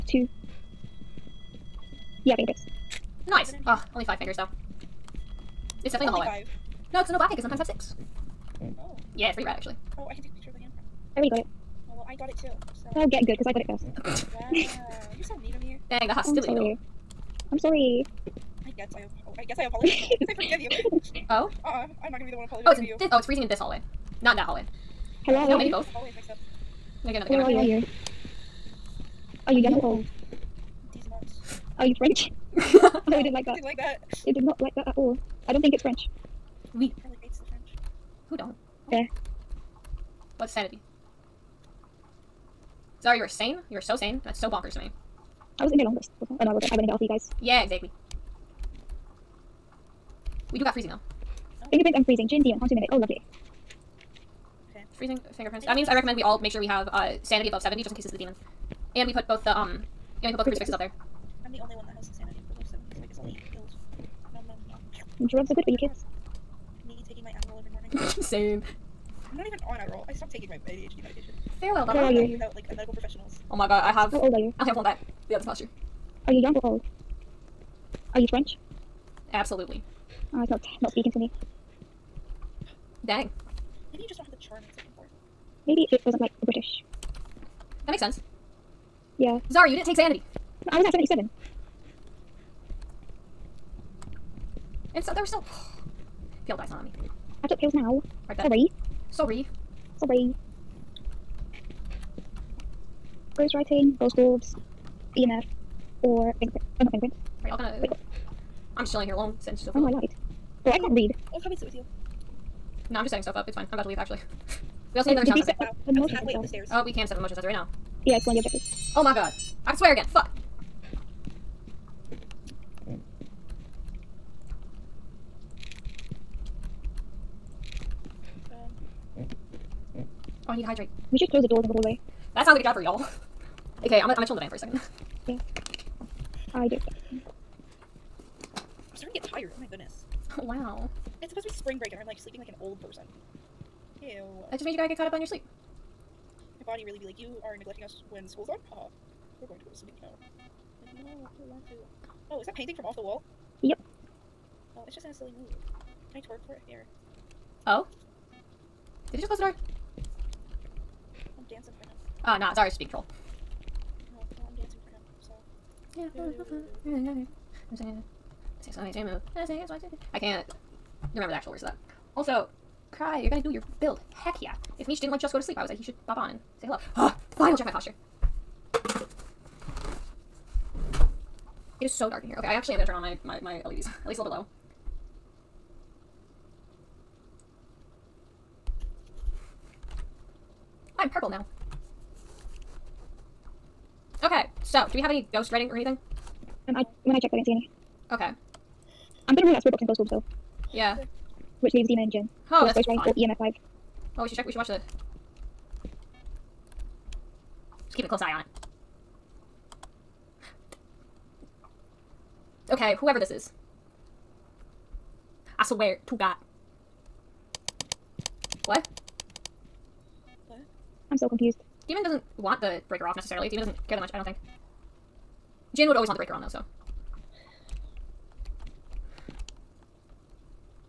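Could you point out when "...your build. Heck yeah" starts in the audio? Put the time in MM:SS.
02:53.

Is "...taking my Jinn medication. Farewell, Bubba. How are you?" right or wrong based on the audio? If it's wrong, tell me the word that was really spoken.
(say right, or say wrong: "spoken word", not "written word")
wrong: "ADHD", not "Jinn".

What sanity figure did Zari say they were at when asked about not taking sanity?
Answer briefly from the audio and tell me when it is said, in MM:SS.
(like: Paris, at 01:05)
77, at 01:30.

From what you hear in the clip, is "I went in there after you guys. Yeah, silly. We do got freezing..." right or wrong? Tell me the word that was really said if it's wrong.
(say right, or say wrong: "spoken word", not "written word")
wrong: "exactly", not "silly".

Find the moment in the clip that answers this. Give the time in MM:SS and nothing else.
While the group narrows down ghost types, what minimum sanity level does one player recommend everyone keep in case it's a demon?
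00:57.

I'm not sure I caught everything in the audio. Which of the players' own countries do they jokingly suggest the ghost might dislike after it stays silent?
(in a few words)
British.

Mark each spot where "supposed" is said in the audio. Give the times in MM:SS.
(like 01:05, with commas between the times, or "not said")
02:21.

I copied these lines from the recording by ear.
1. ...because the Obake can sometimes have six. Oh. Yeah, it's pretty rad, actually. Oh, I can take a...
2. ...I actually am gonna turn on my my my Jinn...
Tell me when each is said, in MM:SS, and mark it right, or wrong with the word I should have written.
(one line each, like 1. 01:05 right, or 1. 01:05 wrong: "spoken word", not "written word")
1. 00:07 right
2. 03:02 wrong: "LEDs", not "Jinn".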